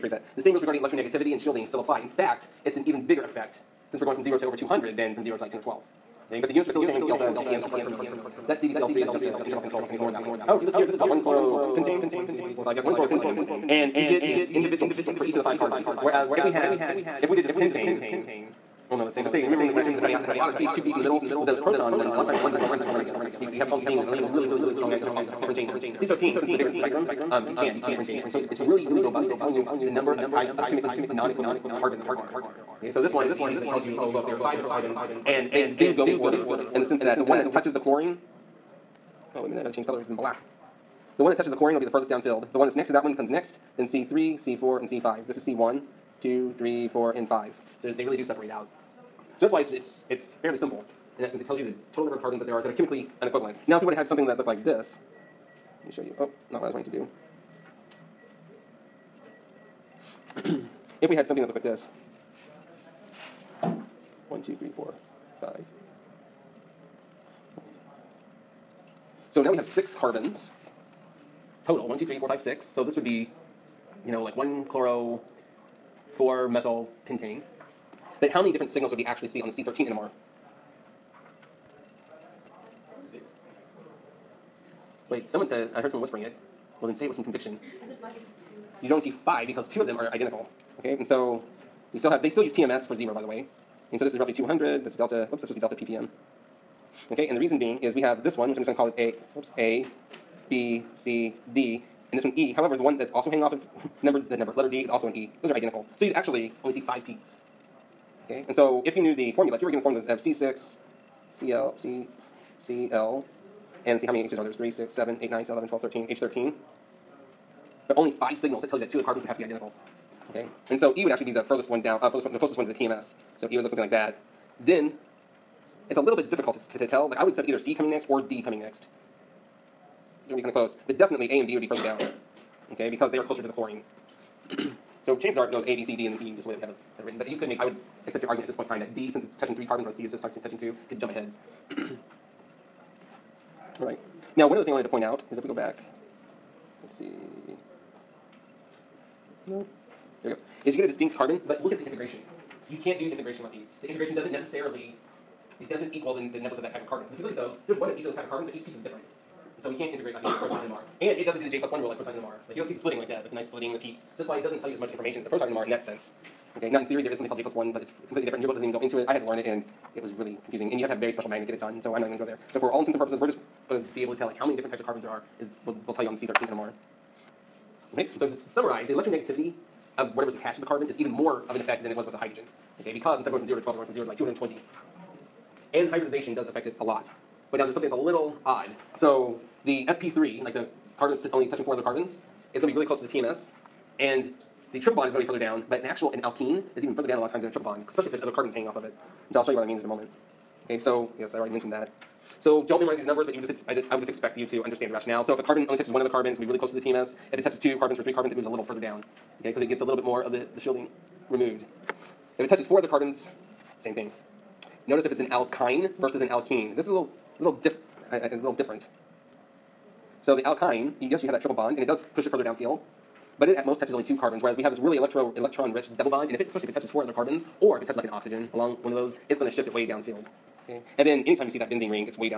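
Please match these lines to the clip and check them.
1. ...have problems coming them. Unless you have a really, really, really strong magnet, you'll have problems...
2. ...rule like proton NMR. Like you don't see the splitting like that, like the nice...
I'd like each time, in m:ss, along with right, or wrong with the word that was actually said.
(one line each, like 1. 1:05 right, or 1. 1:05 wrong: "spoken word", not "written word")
1. 0:23 wrong: "seeing", not "coming"
2. 2:41 right.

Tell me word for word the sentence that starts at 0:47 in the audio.
So they really do separate out.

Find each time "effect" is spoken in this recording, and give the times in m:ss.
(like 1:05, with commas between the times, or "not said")
0:03, 3:01.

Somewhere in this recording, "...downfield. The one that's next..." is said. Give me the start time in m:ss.
0:42.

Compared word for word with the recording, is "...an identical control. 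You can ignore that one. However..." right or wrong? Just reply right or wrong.
wrong.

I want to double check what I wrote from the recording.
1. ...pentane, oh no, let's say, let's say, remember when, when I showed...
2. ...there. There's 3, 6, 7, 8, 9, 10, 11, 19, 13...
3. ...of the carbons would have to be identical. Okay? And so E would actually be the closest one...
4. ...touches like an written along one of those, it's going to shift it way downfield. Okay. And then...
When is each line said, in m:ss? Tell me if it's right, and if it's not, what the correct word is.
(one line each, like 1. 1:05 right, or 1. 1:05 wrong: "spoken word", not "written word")
1. 0:17 right
2. 1:54 wrong: "12", not "19"
3. 1:58 wrong: "furthest", not "closest"
4. 3:47 wrong: "oxygen", not "written".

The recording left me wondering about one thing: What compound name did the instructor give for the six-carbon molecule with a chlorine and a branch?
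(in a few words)
1-chloro-4-methylpentane.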